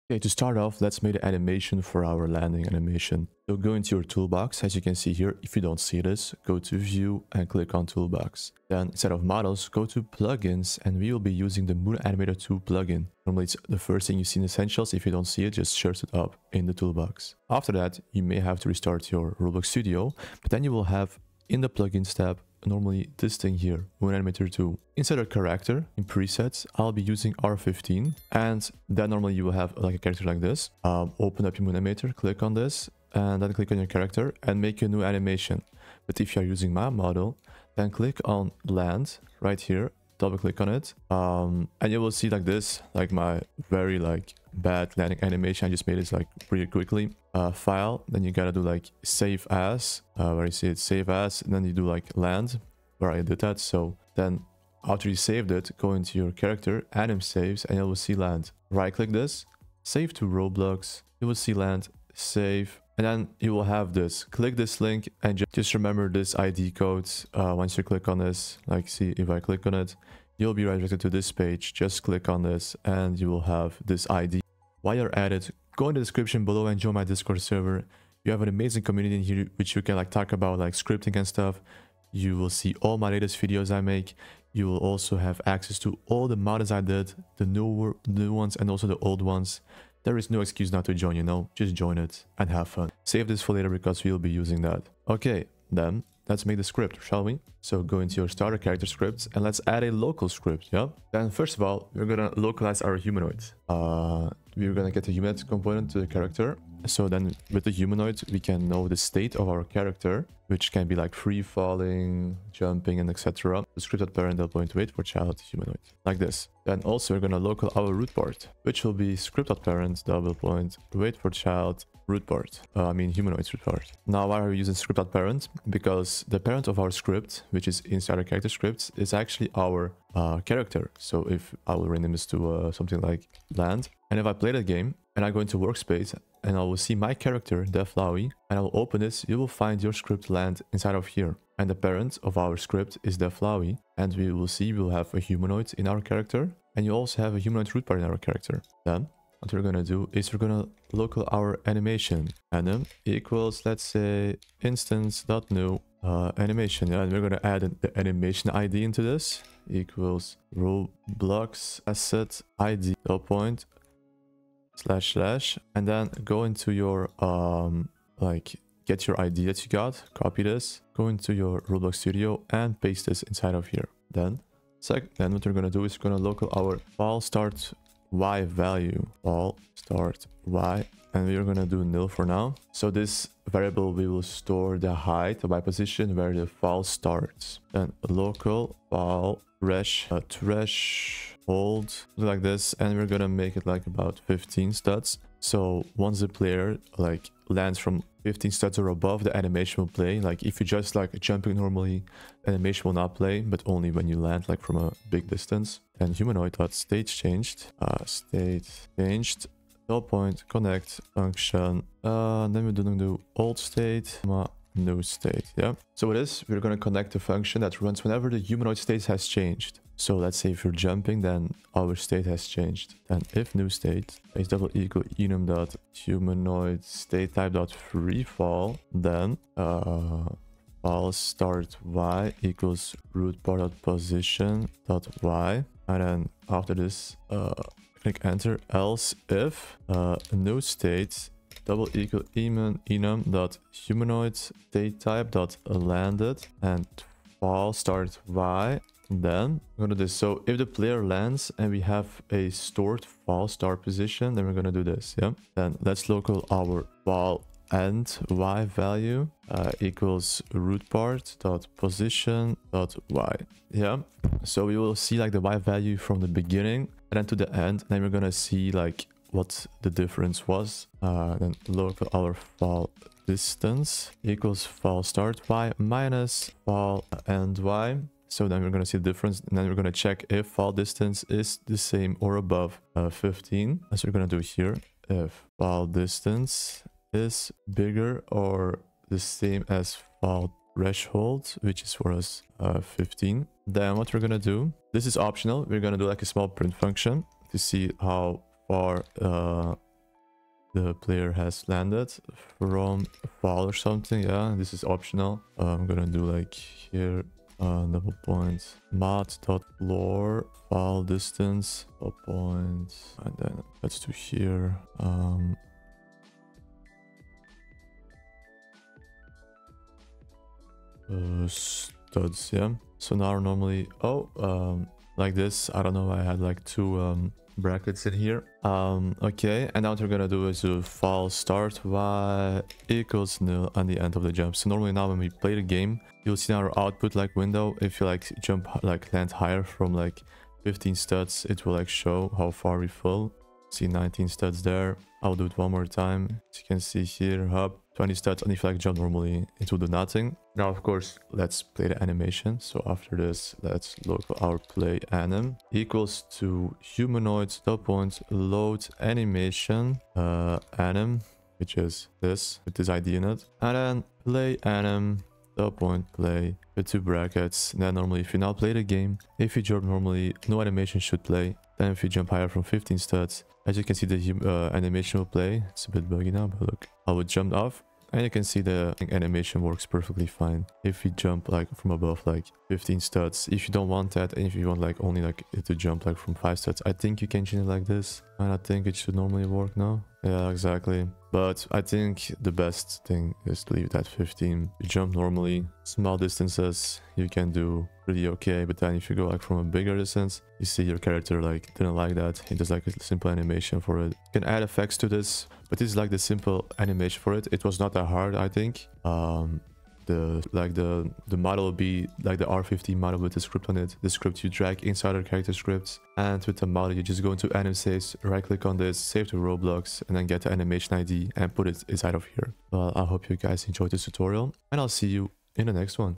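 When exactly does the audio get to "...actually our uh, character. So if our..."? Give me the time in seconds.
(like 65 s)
129 s.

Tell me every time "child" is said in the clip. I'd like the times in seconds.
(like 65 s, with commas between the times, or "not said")
115 s, 121 s.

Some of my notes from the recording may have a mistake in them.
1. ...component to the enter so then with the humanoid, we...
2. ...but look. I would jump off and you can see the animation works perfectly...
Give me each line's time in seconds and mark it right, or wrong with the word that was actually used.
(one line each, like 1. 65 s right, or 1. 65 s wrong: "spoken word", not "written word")
1. 105 s wrong: "character", not "enter"
2. 376 s right.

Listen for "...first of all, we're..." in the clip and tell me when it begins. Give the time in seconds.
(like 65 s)
101 s.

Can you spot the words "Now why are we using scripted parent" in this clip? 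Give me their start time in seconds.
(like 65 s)
124 s.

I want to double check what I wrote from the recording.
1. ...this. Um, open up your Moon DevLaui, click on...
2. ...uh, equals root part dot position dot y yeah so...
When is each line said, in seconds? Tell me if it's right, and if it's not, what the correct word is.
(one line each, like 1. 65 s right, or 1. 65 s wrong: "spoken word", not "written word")
1. 30 s wrong: "Animator", not "DevLaui"
2. 259 s right.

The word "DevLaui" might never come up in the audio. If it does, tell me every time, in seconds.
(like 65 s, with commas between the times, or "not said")
137 s, 143 s.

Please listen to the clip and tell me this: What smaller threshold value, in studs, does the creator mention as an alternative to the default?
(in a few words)
5.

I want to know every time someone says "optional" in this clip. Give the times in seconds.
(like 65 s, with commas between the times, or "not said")
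295 s, 304 s.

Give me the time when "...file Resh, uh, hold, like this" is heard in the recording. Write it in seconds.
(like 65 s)
188 s.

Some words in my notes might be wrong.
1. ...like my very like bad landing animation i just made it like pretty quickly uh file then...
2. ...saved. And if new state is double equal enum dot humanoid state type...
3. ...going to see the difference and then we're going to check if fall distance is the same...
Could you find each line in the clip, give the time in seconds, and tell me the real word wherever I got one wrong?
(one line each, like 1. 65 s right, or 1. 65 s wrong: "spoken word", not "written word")
1. 42 s right
2. 222 s wrong: "changed", not "saved"
3. 278 s right.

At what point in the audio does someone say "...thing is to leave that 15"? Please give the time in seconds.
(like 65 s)
393 s.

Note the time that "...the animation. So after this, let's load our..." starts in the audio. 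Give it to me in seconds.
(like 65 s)
351 s.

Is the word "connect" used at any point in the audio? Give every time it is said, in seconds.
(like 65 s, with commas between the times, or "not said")
210 s, 216 s.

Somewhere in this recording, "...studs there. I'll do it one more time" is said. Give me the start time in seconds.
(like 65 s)
344 s.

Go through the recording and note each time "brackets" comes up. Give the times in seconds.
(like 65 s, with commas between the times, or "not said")
327 s, 367 s.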